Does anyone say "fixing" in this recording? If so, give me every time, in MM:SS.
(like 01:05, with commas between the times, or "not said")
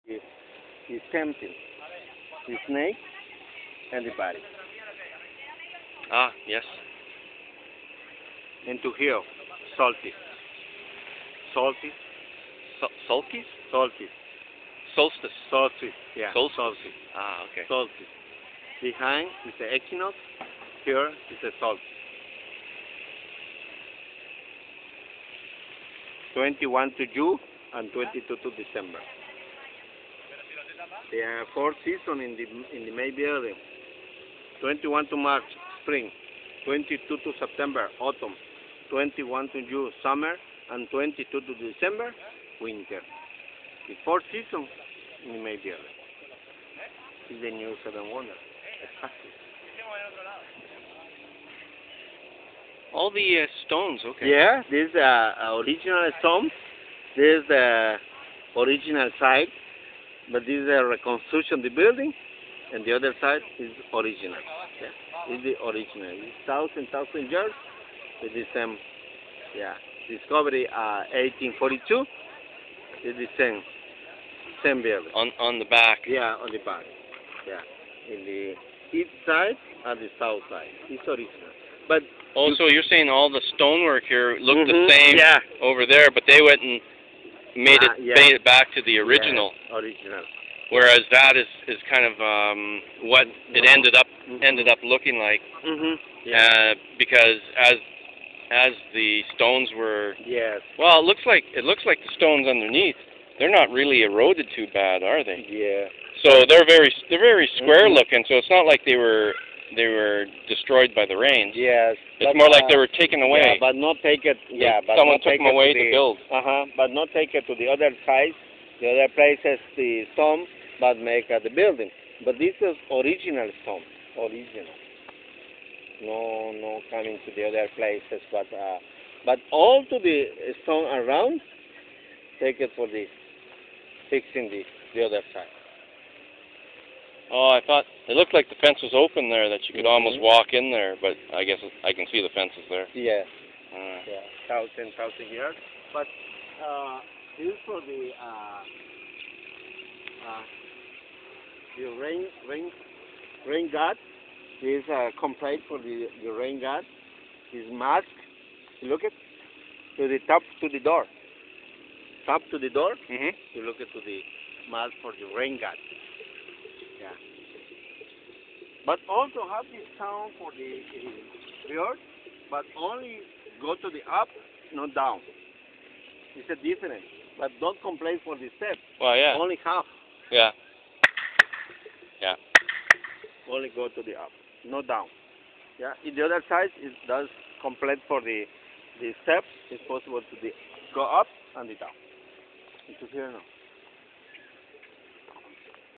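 02:14.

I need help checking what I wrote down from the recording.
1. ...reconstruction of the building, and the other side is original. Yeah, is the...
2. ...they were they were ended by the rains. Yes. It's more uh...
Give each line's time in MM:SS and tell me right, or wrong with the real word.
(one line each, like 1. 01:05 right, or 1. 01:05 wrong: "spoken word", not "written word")
1. 01:00 right
2. 01:48 wrong: "destroyed", not "ended".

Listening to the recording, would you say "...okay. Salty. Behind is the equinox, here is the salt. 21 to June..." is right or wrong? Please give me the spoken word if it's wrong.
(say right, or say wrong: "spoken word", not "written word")
right.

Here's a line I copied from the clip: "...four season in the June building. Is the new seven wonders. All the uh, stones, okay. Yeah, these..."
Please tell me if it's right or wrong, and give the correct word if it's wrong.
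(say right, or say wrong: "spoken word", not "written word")
wrong: "May", not "June".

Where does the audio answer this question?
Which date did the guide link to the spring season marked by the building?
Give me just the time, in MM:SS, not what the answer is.
00:34.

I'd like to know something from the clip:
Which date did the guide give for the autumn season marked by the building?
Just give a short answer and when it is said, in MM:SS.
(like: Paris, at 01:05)
22 September, at 00:36.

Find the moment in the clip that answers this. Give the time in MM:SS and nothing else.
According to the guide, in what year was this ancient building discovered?
01:11.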